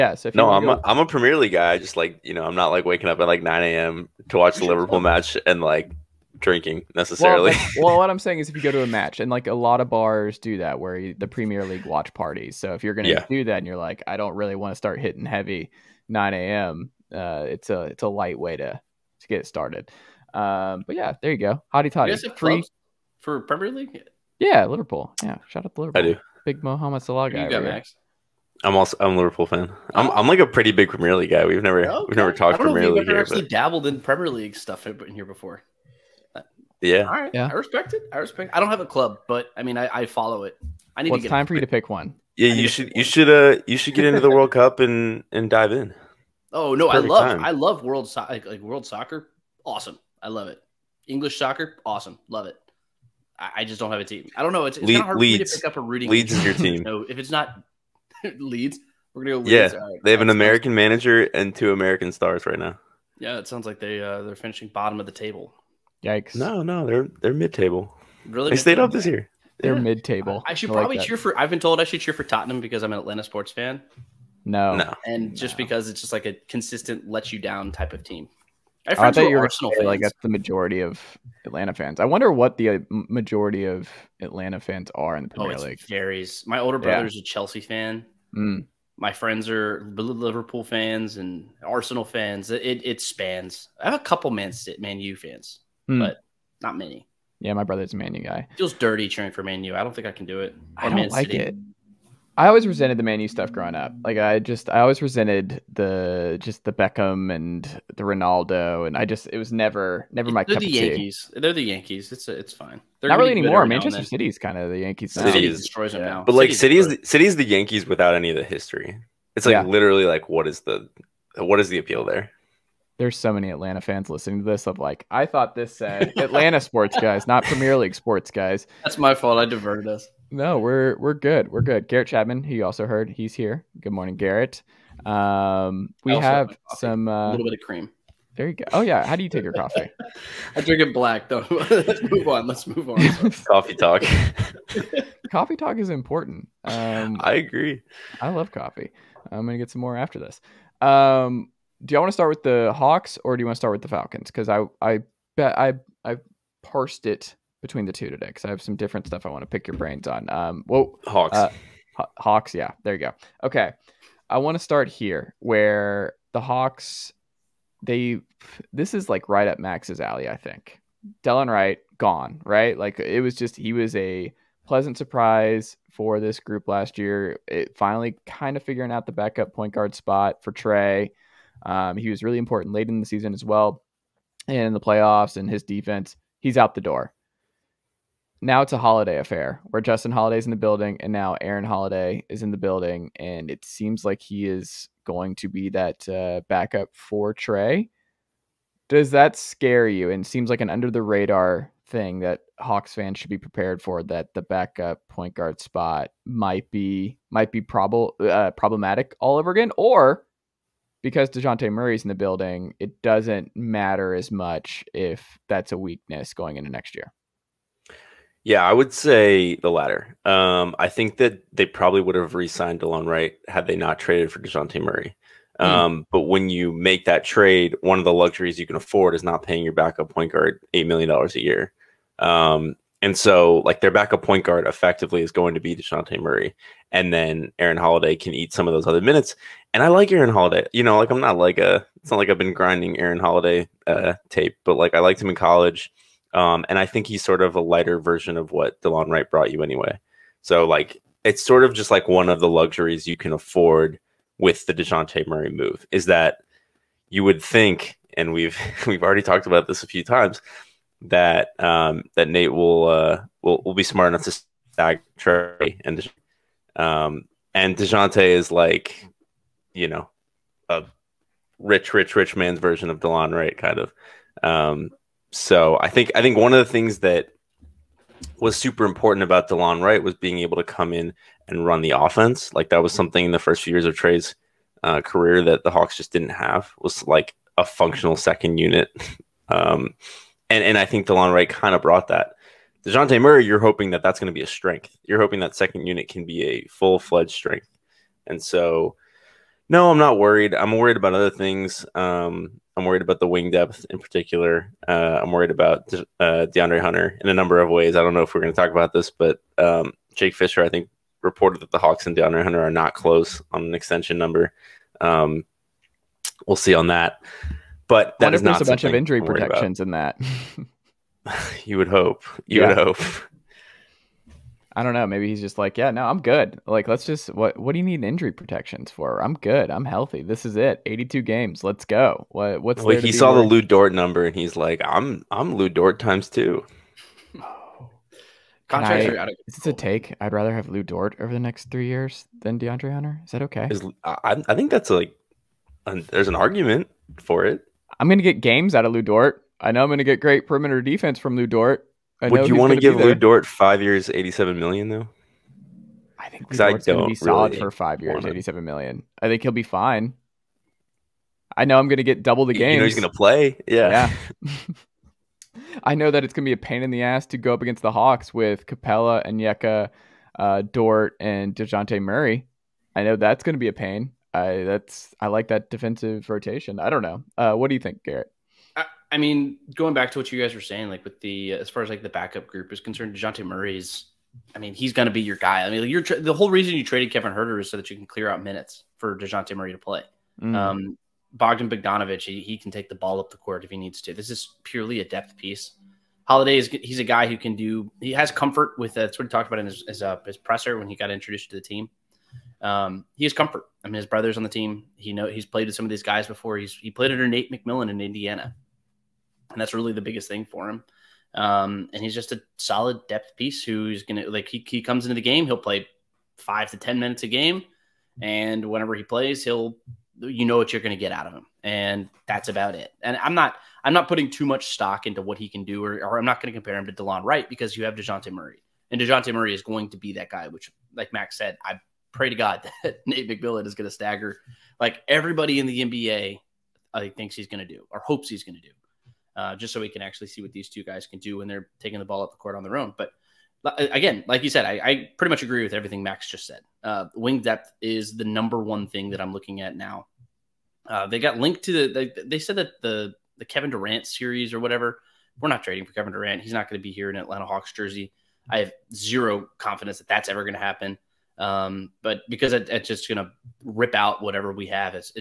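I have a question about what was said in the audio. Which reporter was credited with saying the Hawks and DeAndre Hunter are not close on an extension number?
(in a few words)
Jake Fisher.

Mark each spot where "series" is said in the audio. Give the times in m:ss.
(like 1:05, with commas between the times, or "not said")
7:34.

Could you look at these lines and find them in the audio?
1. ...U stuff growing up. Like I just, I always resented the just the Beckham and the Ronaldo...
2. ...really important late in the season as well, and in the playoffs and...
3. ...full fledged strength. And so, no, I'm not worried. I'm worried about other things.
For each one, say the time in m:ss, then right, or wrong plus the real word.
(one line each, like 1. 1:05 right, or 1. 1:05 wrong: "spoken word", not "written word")
1. 1:43 right
2. 3:02 right
3. 4:56 right.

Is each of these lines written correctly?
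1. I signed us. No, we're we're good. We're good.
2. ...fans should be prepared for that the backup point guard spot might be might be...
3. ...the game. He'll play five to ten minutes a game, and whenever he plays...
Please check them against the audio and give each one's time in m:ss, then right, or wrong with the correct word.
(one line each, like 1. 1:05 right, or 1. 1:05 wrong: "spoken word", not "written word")
1. 2:09 wrong: "diverted", not "signed"
2. 3:22 right
3. 6:55 right.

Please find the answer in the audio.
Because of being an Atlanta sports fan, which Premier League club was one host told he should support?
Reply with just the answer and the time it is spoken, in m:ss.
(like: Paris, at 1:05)
Tottenham, at 1:12.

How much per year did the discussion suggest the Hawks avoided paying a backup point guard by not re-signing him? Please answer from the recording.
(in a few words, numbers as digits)
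$8 million.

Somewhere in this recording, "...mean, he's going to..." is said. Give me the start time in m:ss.
6:24.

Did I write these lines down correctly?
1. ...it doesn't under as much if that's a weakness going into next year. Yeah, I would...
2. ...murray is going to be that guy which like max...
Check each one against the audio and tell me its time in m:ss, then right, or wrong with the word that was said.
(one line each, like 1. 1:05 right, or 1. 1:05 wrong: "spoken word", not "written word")
1. 3:32 wrong: "matter", not "under"
2. 7:09 right.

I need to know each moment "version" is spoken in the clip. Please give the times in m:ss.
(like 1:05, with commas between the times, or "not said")
4:07, 4:32.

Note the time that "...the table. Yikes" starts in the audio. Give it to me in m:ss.
1:05.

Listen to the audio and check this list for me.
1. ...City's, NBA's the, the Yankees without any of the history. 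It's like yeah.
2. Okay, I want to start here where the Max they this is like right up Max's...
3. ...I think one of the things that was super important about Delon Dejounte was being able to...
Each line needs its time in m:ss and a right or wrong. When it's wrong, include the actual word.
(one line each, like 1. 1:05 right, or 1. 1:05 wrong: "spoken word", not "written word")
1. 1:56 wrong: "City", not "NBA"
2. 2:43 wrong: "Hawks", not "Max"
3. 4:36 wrong: "Wright", not "Dejounte".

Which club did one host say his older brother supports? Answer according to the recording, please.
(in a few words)
Chelsea.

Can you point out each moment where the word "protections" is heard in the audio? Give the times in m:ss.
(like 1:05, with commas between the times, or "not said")
5:19, 5:28.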